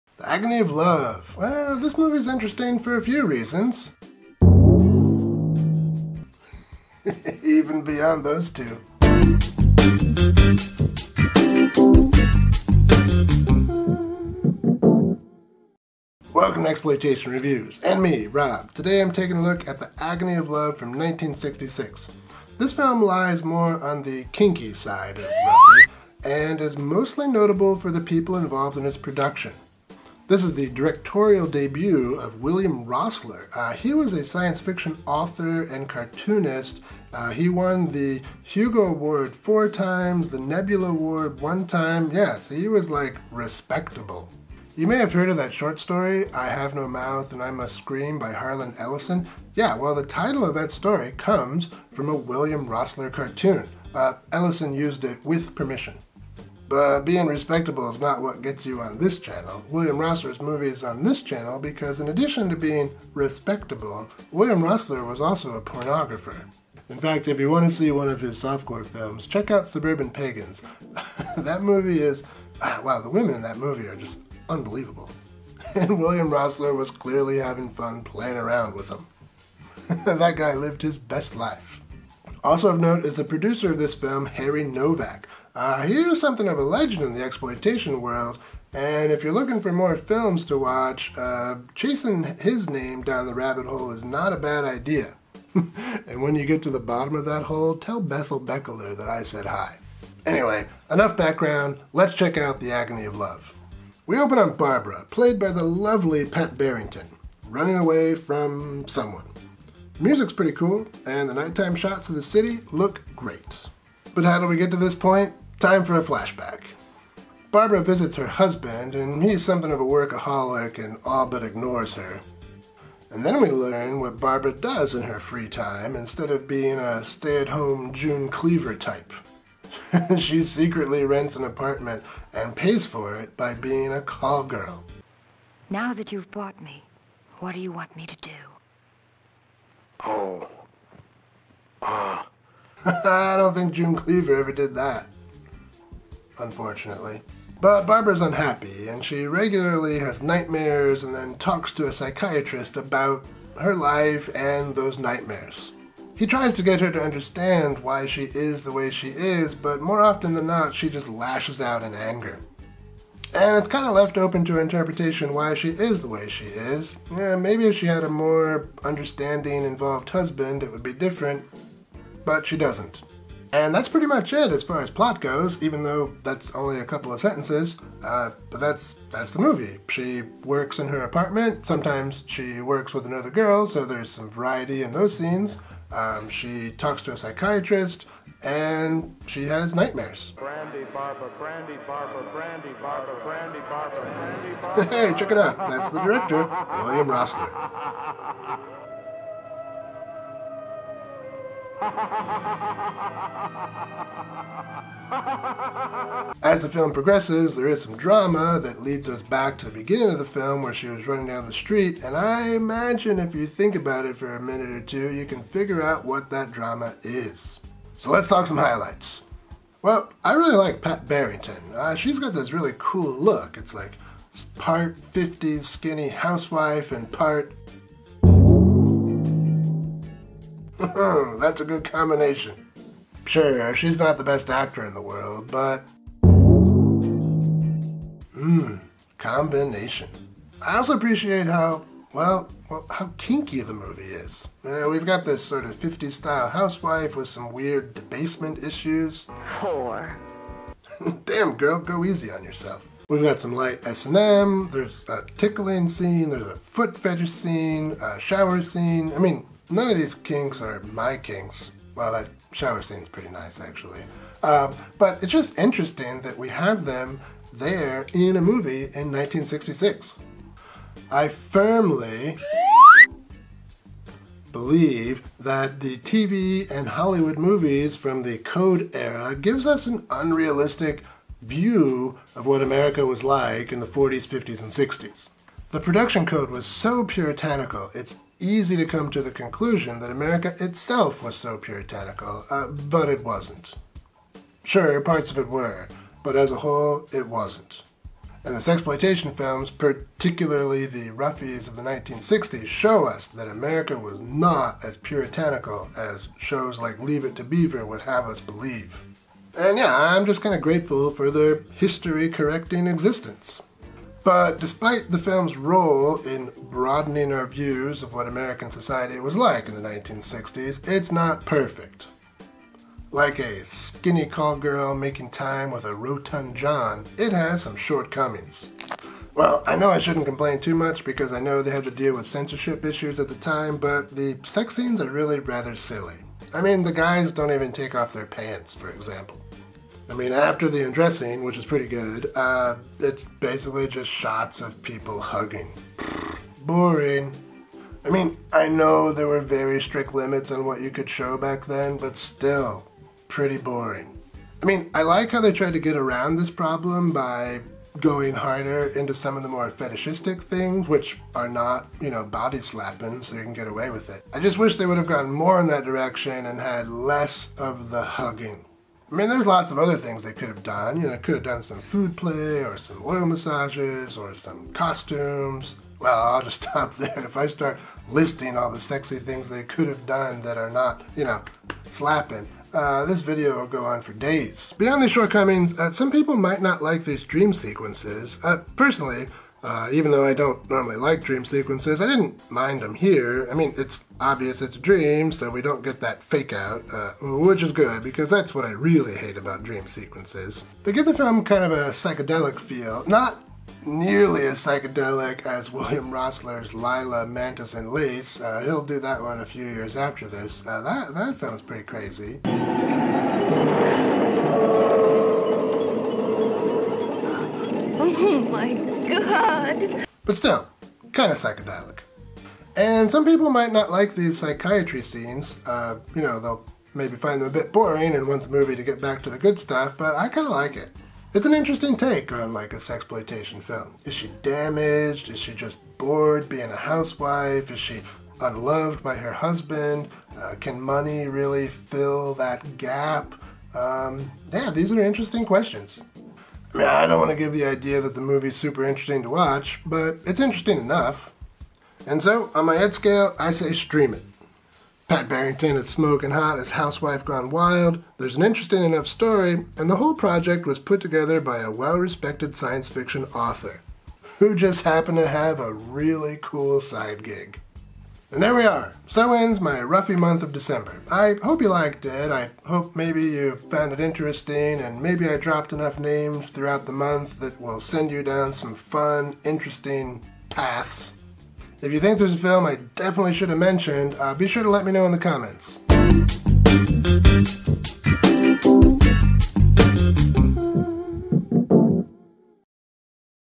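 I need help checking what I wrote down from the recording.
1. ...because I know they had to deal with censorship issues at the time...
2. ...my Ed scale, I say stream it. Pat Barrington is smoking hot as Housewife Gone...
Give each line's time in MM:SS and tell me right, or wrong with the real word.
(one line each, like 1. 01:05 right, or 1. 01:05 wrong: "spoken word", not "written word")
1. 05:31 right
2. 07:32 right.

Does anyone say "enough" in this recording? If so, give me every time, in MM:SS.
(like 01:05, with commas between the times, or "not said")
01:40, 07:30, 07:38, 07:55.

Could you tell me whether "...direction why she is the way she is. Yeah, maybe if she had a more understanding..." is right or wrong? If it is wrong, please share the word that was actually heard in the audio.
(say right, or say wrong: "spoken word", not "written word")
wrong: "interpretation", not "direction".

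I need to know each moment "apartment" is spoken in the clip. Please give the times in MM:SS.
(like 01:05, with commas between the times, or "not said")
02:11, 03:01.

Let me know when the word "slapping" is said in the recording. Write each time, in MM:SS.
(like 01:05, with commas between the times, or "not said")
06:02, 06:21.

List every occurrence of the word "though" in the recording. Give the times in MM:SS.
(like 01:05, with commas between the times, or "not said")
02:55, 06:30.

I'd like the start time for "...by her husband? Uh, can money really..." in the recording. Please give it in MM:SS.
07:19.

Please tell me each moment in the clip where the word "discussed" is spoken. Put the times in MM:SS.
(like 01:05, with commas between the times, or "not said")
not said.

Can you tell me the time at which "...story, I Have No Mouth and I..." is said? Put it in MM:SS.
00:45.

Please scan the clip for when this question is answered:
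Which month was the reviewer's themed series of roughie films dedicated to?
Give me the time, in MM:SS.
07:50.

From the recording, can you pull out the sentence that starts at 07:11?
It's an interesting take on like a sexploitation film.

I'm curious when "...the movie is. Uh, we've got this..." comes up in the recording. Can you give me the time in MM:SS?
04:03.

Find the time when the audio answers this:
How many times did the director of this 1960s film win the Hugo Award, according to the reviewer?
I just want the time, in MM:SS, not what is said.
00:39.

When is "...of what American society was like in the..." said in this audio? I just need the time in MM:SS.
05:18.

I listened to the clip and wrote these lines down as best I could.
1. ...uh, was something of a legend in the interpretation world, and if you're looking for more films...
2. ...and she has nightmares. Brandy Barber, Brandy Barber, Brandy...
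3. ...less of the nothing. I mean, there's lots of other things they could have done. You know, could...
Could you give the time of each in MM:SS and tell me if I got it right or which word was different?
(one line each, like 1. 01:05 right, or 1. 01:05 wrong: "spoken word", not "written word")
1. 01:25 wrong: "exploitation", not "interpretation"
2. 03:08 right
3. 06:06 wrong: "hugging", not "nothing".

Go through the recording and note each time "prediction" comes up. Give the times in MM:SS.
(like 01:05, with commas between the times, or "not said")
not said.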